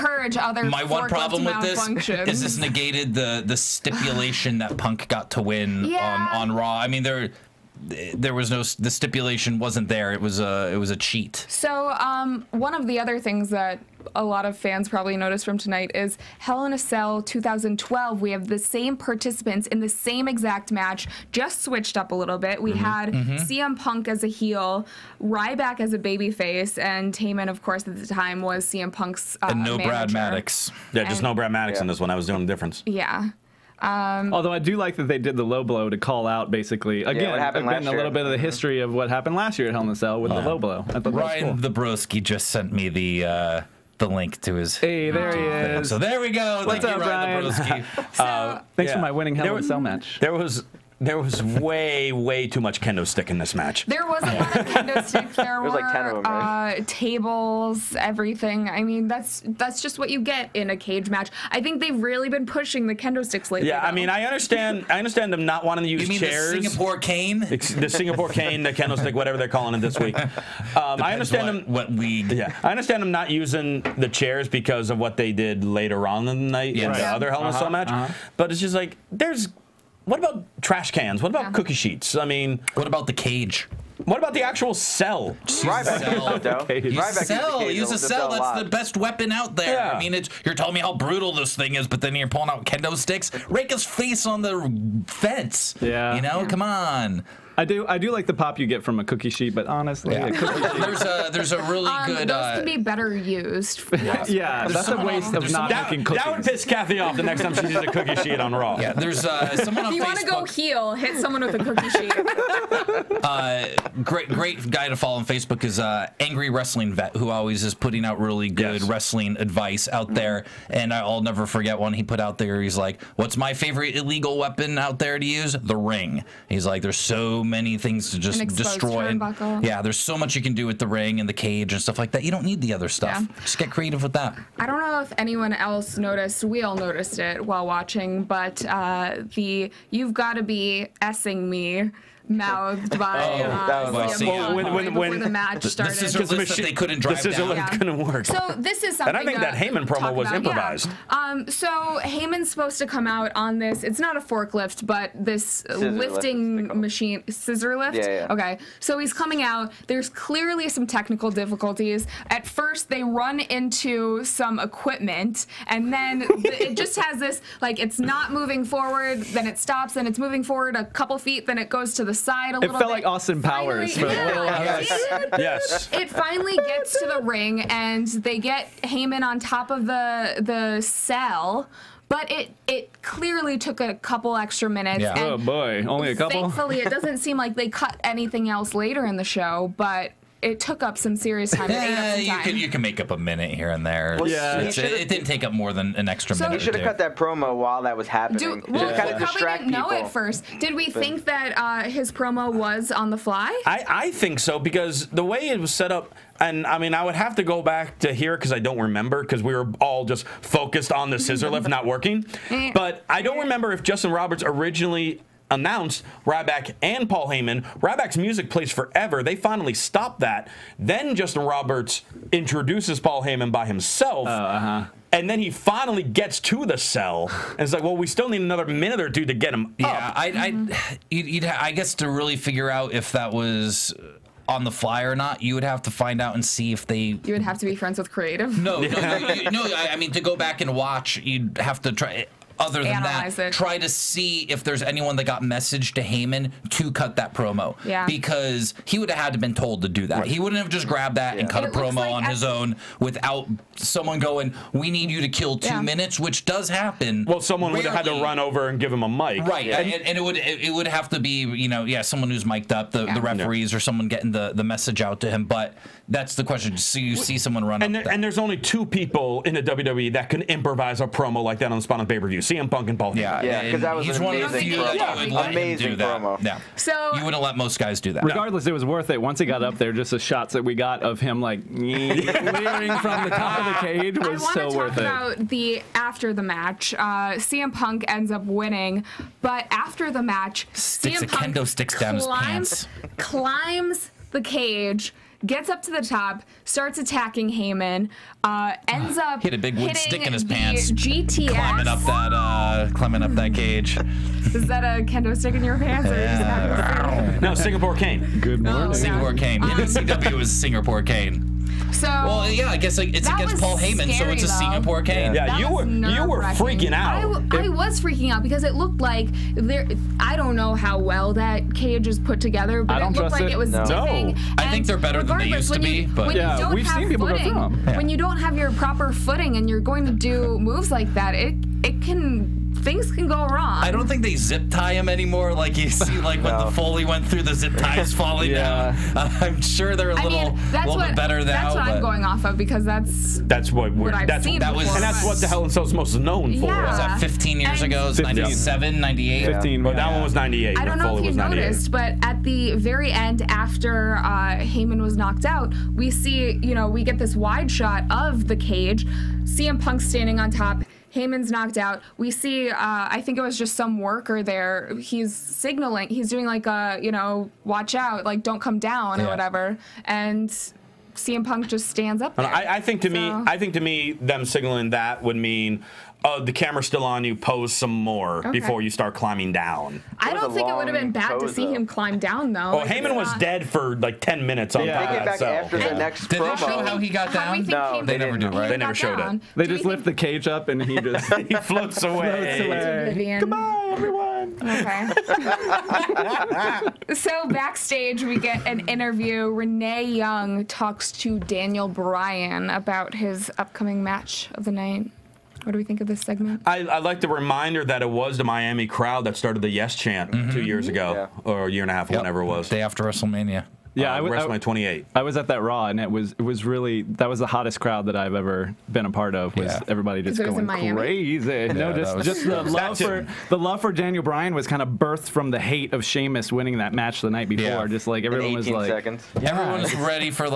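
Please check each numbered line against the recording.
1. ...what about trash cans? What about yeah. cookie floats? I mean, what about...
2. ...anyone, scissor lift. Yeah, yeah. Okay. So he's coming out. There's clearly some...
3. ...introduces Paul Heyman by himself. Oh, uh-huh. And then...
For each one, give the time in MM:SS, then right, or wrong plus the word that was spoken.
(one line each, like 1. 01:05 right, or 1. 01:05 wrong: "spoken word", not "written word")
1. 01:20 wrong: "sheets", not "floats"
2. 02:36 wrong: "machine", not "anyone"
3. 03:42 right.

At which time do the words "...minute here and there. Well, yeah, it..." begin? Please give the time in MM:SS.
03:13.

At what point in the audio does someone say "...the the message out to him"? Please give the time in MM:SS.
04:24.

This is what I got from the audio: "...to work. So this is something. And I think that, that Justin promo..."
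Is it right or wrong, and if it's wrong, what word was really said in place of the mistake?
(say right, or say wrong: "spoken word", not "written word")
wrong: "Heyman", not "Justin".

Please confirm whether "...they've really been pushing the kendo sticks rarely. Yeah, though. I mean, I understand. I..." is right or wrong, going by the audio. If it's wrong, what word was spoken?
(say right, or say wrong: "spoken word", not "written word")
wrong: "lately", not "rarely".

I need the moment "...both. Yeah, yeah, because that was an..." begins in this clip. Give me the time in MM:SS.
04:32.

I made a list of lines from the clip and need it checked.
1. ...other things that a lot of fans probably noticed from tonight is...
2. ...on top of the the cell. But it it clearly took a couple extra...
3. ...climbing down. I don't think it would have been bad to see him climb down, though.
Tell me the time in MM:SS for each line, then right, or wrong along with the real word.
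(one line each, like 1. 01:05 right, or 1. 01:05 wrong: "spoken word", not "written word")
1. 00:12 right
2. 02:59 right
3. 06:19 right.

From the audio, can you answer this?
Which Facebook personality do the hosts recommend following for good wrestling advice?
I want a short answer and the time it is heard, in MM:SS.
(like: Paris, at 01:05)
Angry Wrestling Vet, at 01:56.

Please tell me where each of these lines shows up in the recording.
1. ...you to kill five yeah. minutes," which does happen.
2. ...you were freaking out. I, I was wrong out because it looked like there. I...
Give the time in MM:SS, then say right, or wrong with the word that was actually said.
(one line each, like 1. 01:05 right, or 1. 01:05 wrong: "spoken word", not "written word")
1. 04:15 wrong: "two", not "five"
2. 05:16 wrong: "freaking", not "wrong".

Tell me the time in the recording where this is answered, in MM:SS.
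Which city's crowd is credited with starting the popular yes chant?
06:48.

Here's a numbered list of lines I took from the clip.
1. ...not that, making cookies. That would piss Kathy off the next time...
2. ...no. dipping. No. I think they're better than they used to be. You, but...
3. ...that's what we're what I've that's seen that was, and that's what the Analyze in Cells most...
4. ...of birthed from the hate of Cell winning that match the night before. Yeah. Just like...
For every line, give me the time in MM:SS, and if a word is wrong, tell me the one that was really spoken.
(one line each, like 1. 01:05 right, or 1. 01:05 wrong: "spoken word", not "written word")
1. 01:45 right
2. 05:23 right
3. 05:43 wrong: "Hell", not "Analyze"
4. 07:04 wrong: "Sheamus", not "Cell".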